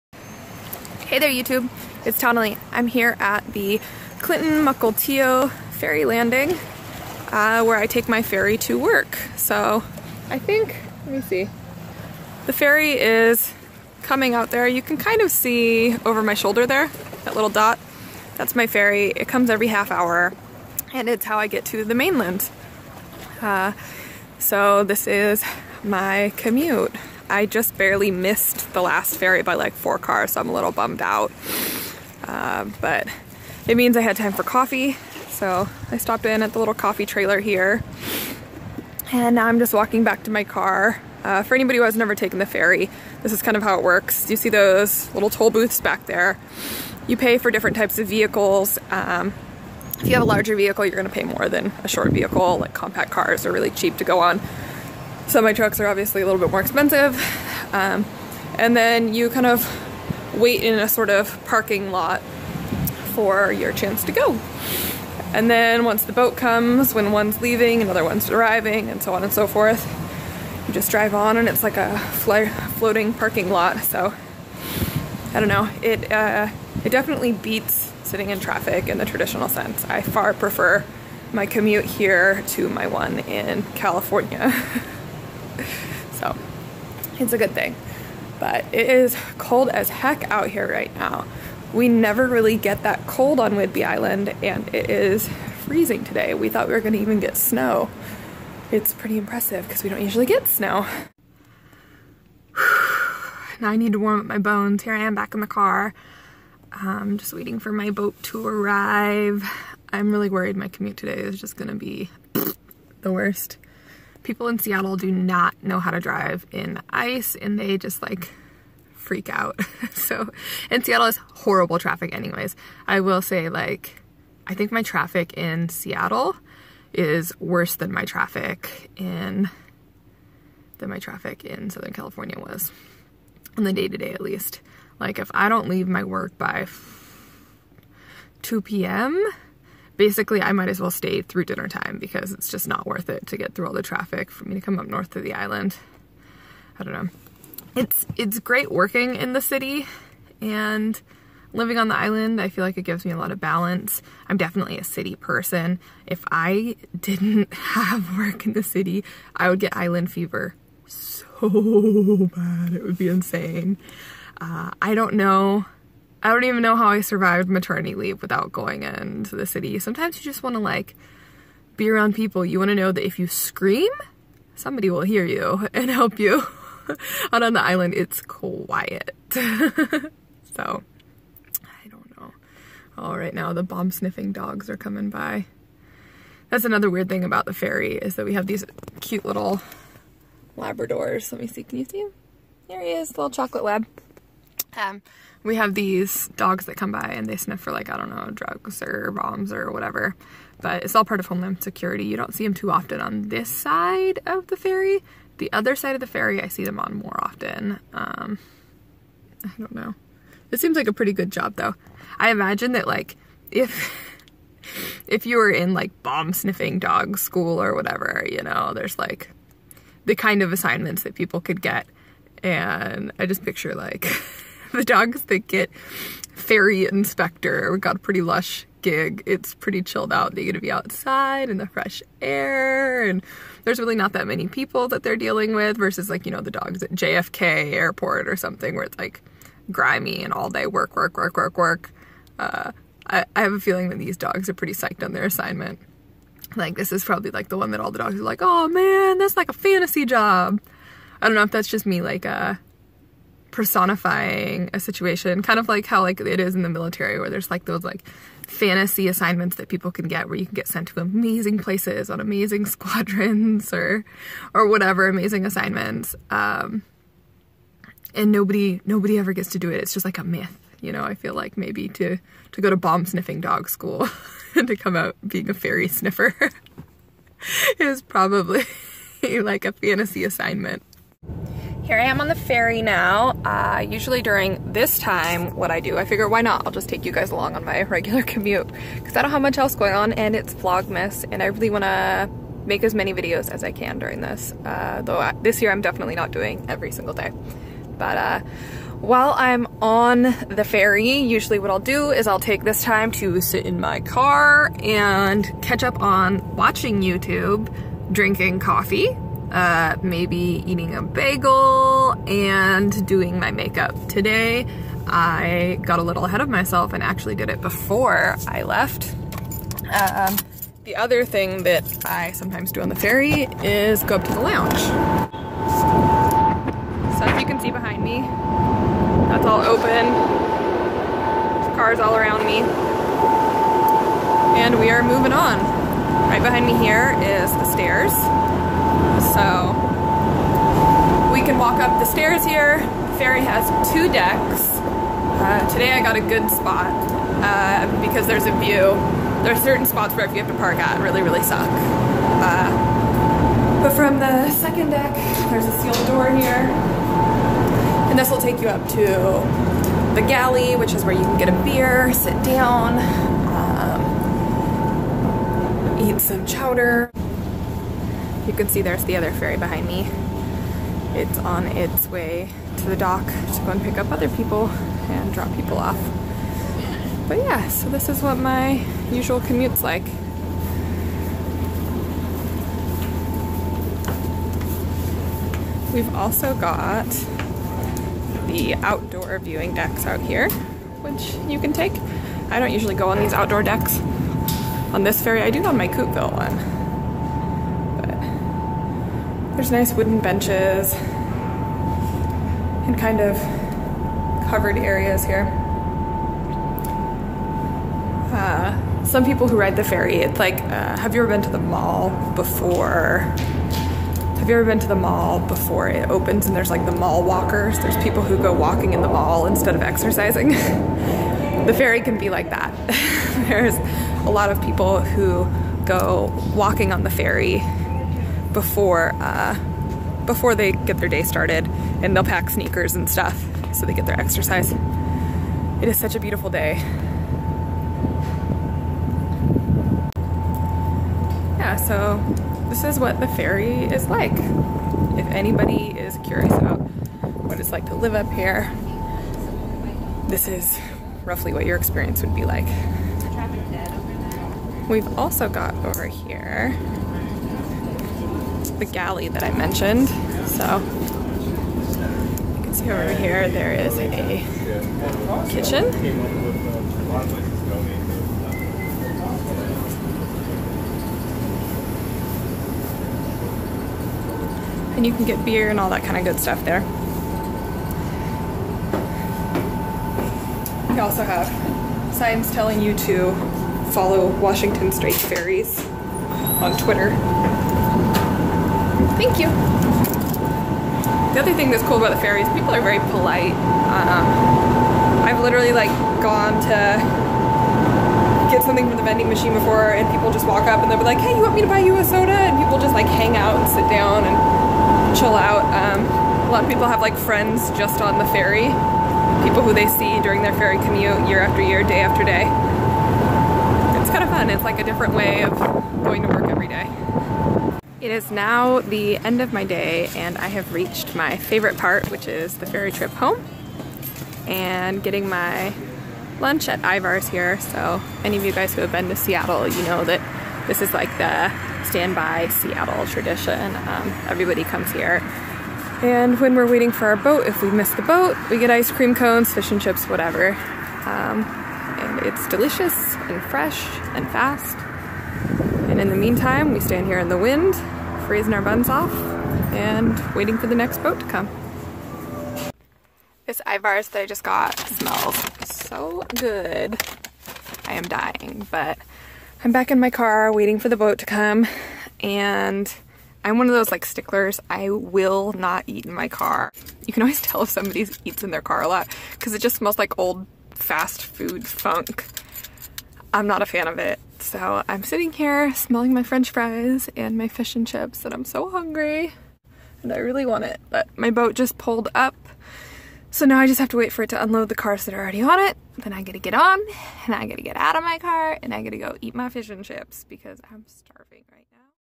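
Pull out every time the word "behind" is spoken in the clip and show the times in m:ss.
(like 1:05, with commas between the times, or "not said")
5:27, 5:36, 6:09.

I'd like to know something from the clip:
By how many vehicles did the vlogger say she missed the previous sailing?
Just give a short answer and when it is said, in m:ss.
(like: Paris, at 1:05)
4 cars, at 0:29.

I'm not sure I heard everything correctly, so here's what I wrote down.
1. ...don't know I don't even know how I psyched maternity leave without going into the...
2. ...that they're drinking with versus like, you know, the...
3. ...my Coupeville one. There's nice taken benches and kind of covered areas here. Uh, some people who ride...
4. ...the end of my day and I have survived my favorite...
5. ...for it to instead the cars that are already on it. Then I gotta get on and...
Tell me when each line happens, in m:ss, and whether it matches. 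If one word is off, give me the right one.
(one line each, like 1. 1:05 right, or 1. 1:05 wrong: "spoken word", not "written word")
1. 2:44 wrong: "survived", not "psyched"
2. 3:54 wrong: "dealing", not "drinking"
3. 6:35 wrong: "wooden", not "taken"
4. 8:38 wrong: "reached", not "survived"
5. 9:44 wrong: "unload", not "instead".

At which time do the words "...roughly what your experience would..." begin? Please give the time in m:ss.
7:31.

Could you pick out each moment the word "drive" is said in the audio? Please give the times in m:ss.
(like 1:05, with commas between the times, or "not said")
1:10, 1:55.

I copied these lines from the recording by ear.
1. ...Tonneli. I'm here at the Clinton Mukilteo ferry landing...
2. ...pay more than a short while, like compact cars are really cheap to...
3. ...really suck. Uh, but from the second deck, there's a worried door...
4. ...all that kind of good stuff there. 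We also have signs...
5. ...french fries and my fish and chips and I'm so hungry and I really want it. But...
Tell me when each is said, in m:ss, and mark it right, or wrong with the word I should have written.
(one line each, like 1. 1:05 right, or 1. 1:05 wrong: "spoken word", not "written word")
1. 0:02 right
2. 0:51 wrong: "vehicle", not "while"
3. 5:51 wrong: "sealed", not "worried"
4. 7:55 right
5. 9:36 right.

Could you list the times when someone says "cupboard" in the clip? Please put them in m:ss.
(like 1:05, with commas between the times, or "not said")
not said.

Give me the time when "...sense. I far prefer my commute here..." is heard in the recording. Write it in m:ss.
1:19.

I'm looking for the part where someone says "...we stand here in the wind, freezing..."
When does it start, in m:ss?
9:06.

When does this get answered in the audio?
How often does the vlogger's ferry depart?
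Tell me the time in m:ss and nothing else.
0:19.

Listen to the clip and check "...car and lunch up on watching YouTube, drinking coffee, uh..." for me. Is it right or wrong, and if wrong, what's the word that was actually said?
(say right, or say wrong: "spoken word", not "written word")
wrong: "catch", not "lunch".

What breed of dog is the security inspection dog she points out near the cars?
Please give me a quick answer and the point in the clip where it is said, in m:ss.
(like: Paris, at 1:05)
Chocolate lab, at 3:13.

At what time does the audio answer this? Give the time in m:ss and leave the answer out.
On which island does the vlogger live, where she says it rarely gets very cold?
1:33.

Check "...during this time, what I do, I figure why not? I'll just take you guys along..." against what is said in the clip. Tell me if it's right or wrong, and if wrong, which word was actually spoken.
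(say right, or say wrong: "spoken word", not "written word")
right.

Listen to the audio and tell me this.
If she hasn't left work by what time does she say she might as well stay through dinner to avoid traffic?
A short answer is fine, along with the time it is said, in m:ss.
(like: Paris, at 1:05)
2 p.m., at 2:18.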